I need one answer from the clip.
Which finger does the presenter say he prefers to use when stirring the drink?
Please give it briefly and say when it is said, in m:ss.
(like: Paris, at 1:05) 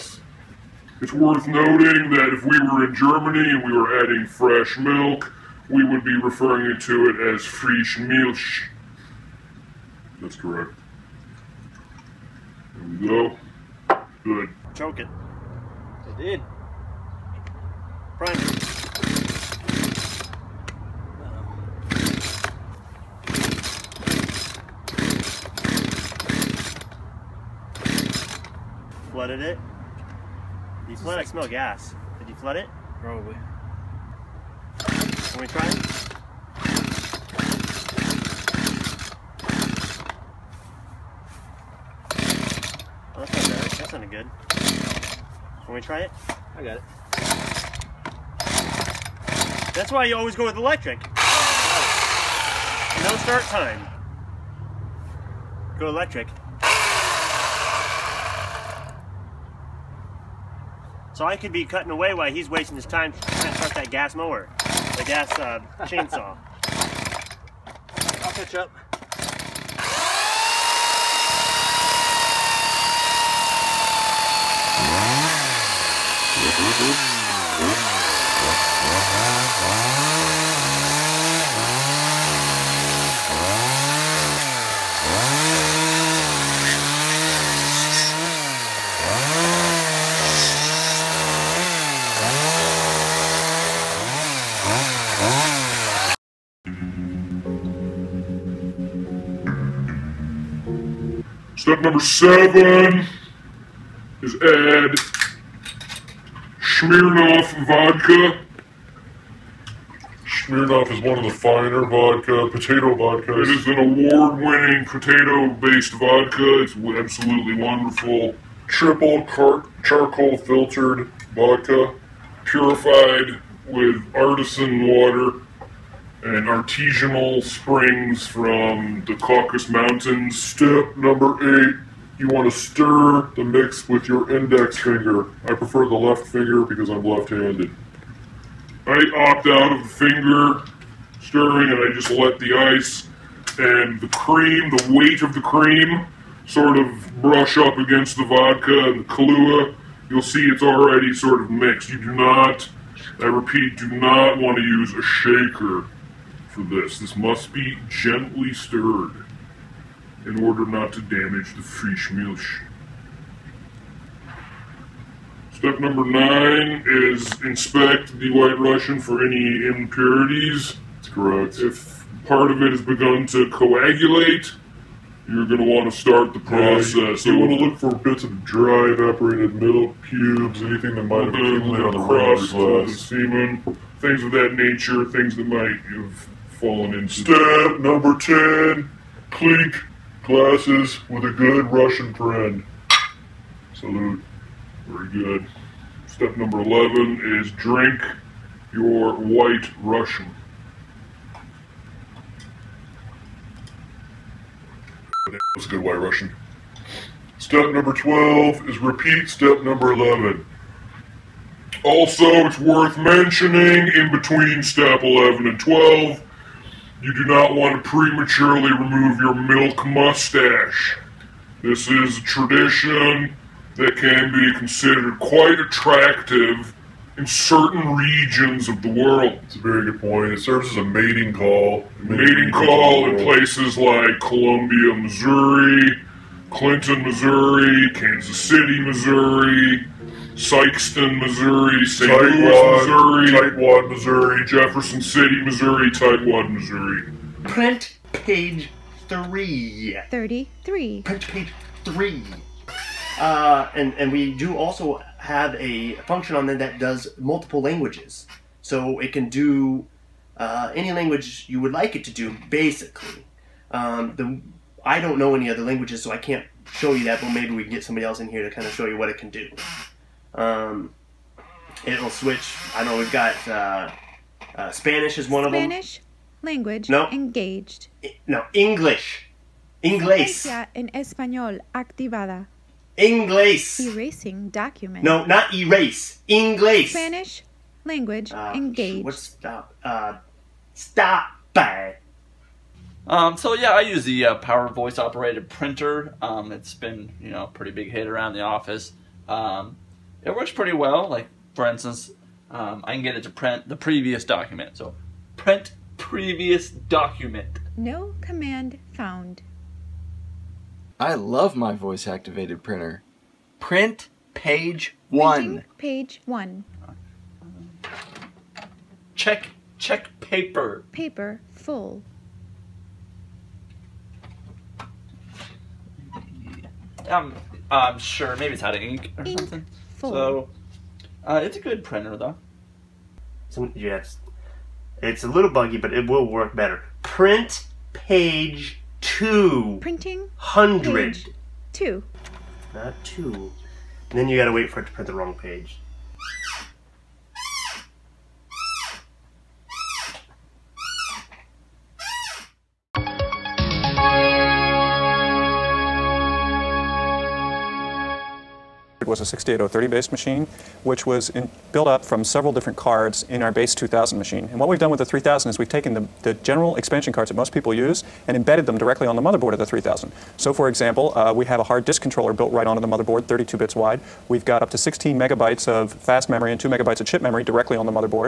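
left finger, at 2:15.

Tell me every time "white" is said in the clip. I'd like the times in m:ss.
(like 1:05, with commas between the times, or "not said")
2:48, 3:19, 3:25.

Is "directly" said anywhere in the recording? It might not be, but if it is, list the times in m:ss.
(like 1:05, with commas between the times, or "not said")
6:08, 6:17.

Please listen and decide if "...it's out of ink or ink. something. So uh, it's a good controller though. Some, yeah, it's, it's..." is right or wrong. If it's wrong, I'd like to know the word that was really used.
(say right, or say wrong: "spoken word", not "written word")
wrong: "printer", not "controller".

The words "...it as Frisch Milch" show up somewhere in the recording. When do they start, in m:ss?
0:07.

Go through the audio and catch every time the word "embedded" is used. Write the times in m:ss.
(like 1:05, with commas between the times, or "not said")
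6:08.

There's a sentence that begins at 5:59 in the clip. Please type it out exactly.
was a 68030 based machine, which was in, built up from several different cards in our base 2000 machine.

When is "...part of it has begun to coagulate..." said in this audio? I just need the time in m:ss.
2:52.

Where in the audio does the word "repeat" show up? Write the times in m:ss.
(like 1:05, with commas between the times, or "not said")
2:33, 3:28.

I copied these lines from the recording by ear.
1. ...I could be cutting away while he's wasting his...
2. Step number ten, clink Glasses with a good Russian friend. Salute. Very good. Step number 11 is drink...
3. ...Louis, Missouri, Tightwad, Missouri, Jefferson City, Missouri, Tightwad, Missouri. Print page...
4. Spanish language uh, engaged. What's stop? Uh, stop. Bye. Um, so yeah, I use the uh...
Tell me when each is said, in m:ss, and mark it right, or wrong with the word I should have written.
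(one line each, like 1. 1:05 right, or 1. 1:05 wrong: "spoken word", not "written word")
1. 1:01 right
2. 3:07 right
3. 4:02 right
4. 4:46 right.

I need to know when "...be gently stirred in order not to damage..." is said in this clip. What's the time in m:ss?
2:37.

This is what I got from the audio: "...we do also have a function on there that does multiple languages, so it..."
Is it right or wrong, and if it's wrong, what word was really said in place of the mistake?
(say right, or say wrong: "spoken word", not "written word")
right.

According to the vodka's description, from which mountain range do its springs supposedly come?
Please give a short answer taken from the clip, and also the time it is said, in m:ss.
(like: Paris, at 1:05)
Caucasus Mountains, at 2:09.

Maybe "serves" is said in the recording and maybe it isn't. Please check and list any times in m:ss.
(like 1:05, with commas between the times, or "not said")
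3:50.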